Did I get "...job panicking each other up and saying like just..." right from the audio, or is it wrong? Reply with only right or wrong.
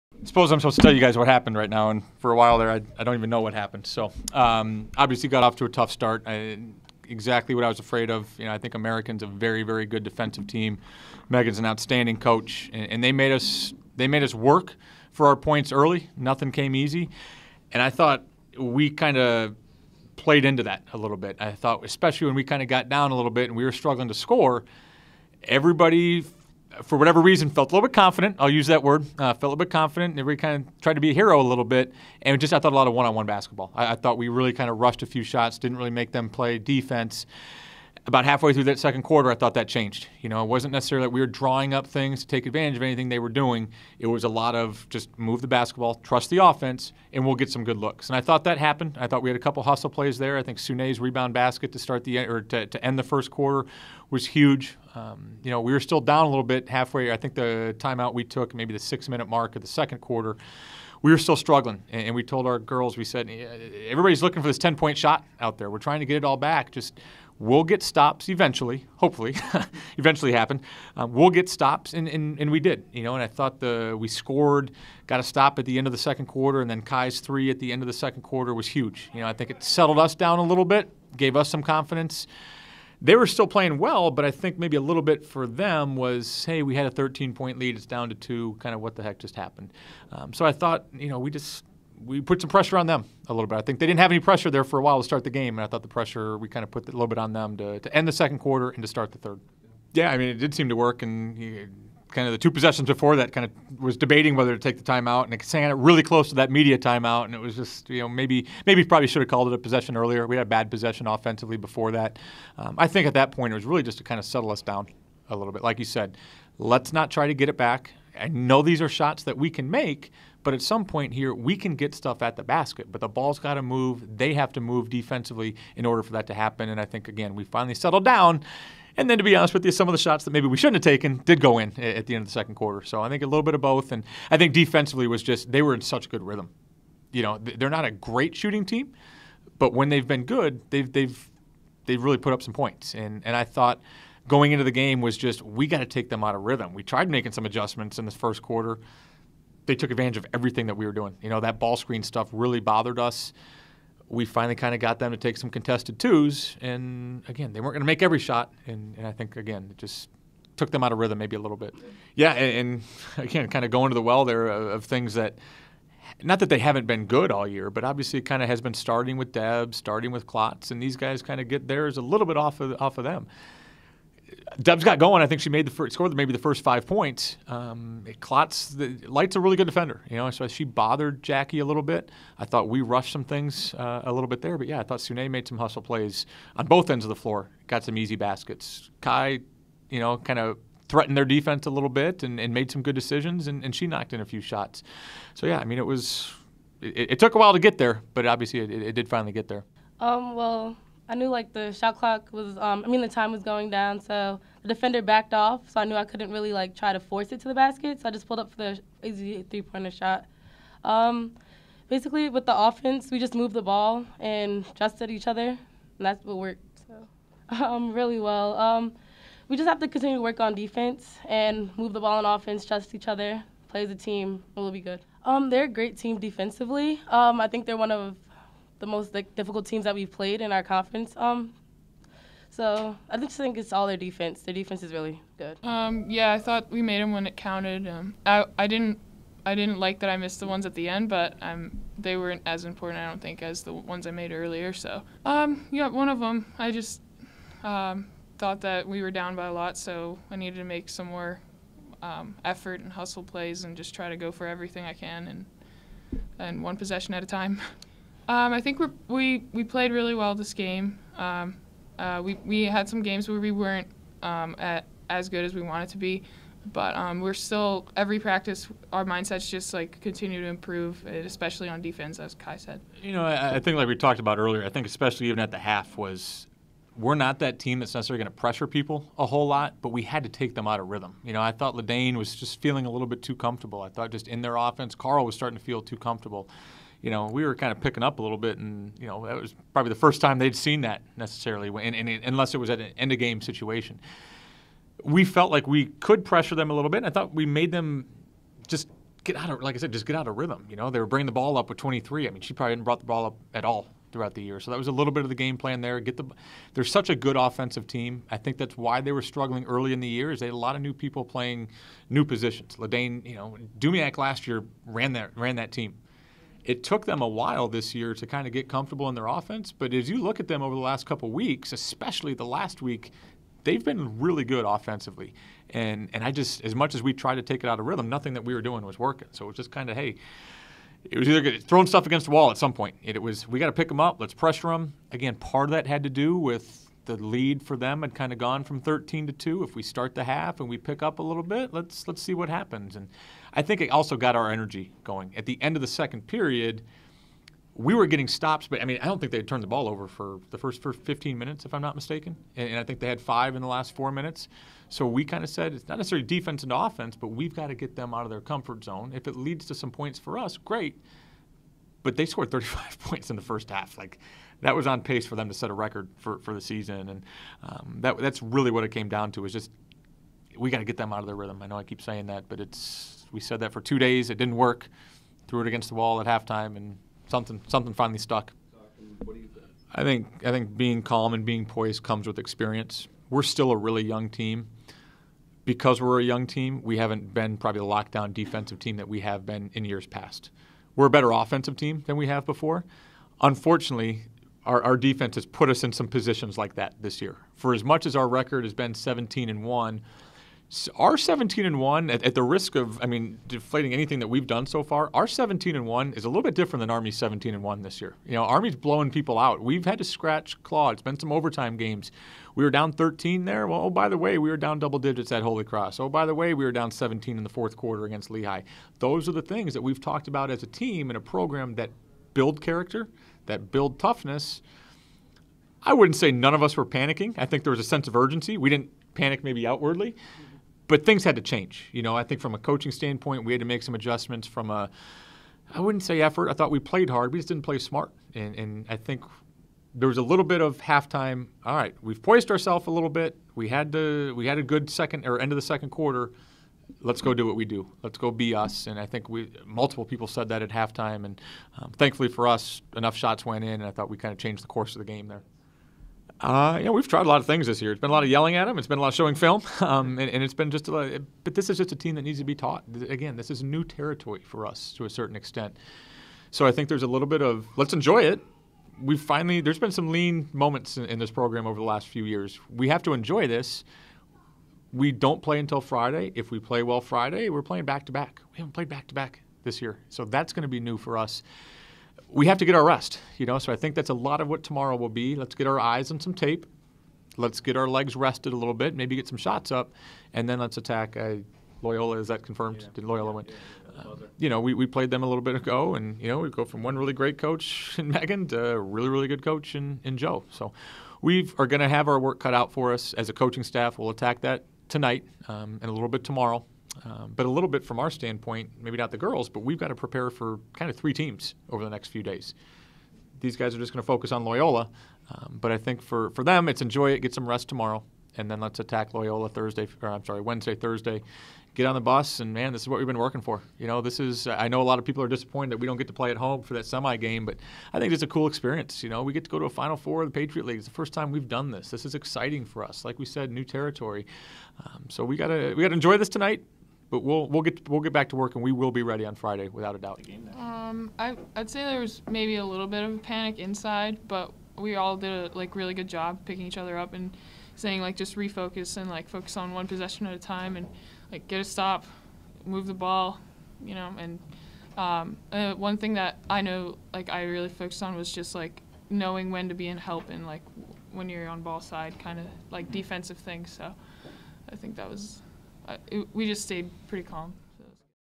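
wrong.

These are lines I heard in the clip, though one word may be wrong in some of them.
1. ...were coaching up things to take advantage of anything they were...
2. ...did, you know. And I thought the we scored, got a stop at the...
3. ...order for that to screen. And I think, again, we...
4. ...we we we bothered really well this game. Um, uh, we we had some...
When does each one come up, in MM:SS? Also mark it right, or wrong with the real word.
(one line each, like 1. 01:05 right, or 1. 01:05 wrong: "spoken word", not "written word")
1. 00:41 wrong: "drawing", not "coaching"
2. 01:12 right
3. 02:05 wrong: "happen", not "screen"
4. 04:18 wrong: "played", not "bothered".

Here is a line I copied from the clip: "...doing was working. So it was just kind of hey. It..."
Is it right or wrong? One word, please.
right.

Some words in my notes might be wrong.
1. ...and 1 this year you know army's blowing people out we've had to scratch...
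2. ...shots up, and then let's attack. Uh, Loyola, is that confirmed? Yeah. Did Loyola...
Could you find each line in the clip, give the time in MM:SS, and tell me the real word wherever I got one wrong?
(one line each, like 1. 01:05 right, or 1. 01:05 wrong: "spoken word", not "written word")
1. 06:47 right
2. 08:09 right.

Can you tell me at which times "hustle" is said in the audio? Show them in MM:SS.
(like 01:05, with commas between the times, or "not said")
00:49, 03:05, 04:12.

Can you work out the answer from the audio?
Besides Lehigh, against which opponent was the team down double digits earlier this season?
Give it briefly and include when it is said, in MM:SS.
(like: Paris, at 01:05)
Holy Cross, at 06:55.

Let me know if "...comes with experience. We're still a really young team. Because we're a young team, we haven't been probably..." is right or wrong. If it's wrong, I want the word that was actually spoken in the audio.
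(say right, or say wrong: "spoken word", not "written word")
right.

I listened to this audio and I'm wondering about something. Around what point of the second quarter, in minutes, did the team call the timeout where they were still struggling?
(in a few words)
6 minute mark.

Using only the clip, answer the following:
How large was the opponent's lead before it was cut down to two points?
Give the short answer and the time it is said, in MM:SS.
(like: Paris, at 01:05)
13 points, at 01:26.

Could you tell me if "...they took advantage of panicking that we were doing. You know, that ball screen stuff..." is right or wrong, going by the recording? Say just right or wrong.
wrong.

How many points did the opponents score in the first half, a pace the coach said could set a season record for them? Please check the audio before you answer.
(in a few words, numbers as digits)
35.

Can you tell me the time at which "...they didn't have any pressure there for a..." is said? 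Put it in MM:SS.
01:33.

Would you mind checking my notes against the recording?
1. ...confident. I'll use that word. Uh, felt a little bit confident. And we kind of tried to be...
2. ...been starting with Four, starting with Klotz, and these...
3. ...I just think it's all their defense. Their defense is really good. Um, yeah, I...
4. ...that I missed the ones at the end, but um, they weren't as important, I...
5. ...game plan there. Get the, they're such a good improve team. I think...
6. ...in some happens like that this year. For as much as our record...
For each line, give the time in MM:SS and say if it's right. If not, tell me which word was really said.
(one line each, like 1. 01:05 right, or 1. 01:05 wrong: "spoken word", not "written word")
1. 00:27 right
2. 02:48 wrong: "Deb", not "Four"
3. 03:53 right
4. 03:59 right
5. 05:05 wrong: "offensive", not "improve"
6. 06:35 wrong: "positions", not "happens".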